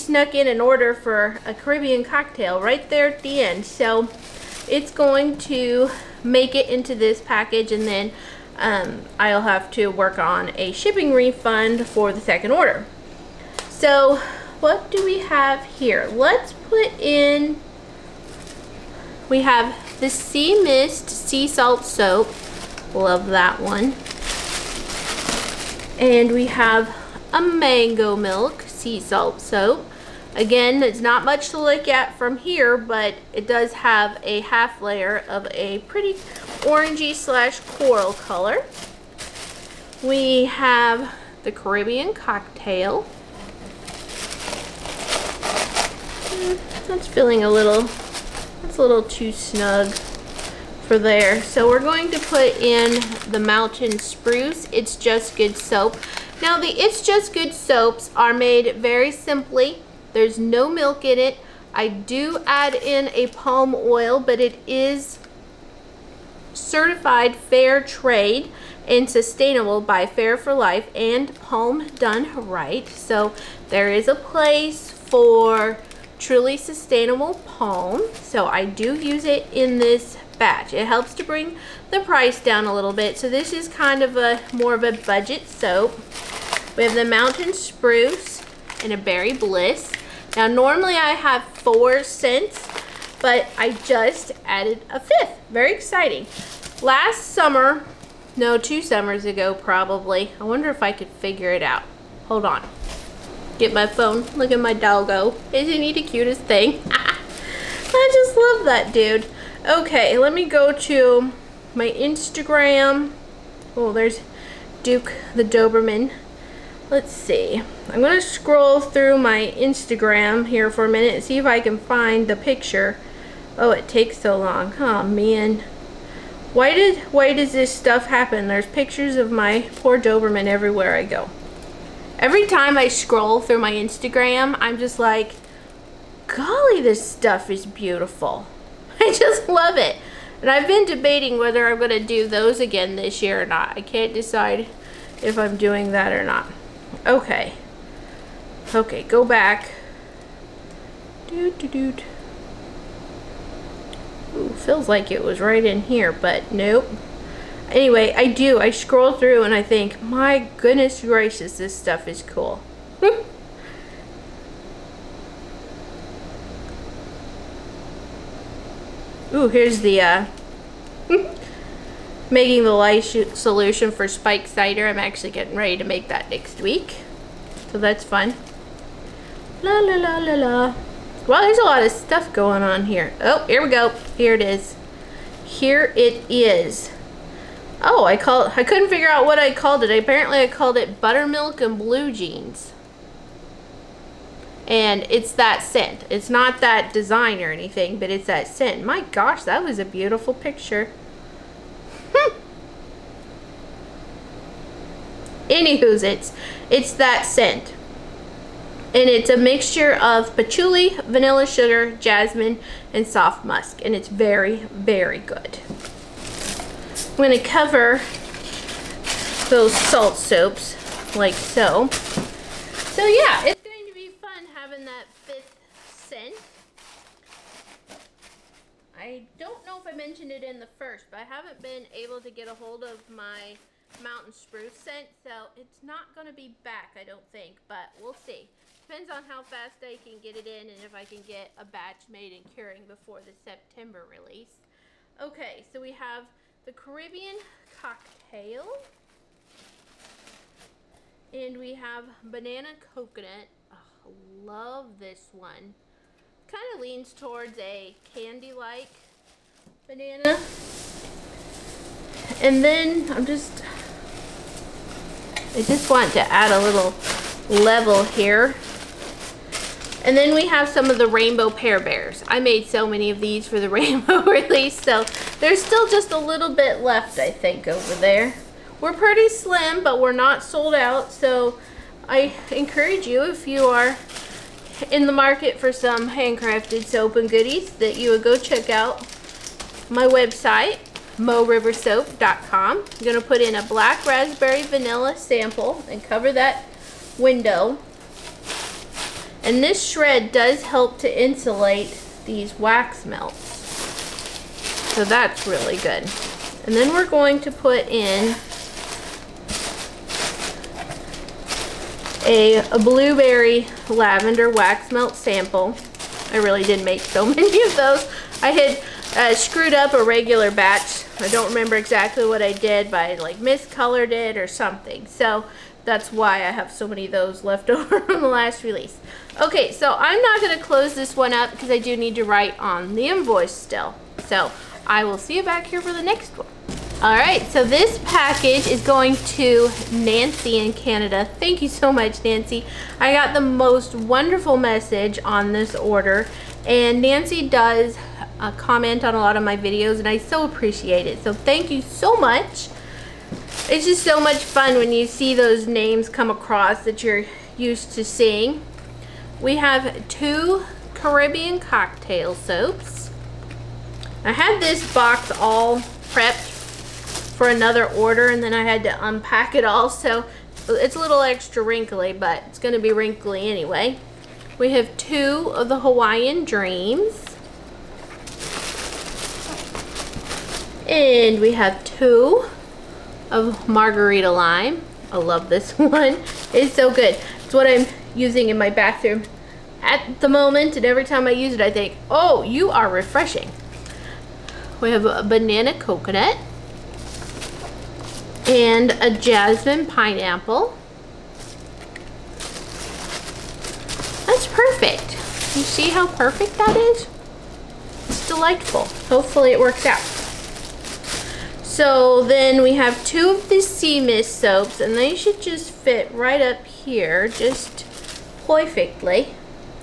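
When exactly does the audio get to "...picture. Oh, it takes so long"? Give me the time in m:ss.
2:02.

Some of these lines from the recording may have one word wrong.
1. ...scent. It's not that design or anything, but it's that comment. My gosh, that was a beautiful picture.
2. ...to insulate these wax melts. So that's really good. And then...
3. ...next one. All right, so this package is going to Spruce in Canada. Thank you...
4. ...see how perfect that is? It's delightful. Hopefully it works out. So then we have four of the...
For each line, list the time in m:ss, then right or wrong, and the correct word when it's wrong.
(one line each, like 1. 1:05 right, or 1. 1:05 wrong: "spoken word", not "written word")
1. 3:15 wrong: "scent", not "comment"
2. 5:00 right
3. 5:36 wrong: "Nancy", not "Spruce"
4. 6:45 wrong: "two", not "four".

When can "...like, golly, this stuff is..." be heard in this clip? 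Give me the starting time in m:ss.
2:14.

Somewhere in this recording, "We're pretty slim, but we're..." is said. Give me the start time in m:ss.
4:38.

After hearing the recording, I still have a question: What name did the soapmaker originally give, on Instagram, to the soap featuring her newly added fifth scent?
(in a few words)
Buttermilk and Blue Jeans.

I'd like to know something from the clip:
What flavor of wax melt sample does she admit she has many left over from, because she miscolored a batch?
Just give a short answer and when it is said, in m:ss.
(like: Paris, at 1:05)
Blueberry lavender, at 5:12.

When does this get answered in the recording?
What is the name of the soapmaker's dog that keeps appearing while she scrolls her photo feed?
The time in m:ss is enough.
1:54.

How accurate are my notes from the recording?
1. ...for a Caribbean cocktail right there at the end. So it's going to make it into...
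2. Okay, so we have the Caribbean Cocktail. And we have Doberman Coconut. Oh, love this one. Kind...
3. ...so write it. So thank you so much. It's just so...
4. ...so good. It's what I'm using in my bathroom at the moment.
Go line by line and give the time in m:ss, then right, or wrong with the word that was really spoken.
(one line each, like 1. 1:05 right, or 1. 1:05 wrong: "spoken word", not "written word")
1. 0:00 right
2. 4:05 wrong: "Banana", not "Doberman"
3. 5:50 wrong: "appreciate", not "write"
4. 6:26 right.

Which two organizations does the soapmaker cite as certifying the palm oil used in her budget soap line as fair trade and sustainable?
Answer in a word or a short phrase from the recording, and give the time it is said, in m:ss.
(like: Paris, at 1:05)
Fair for Life and Palm Done Right, at 1:10.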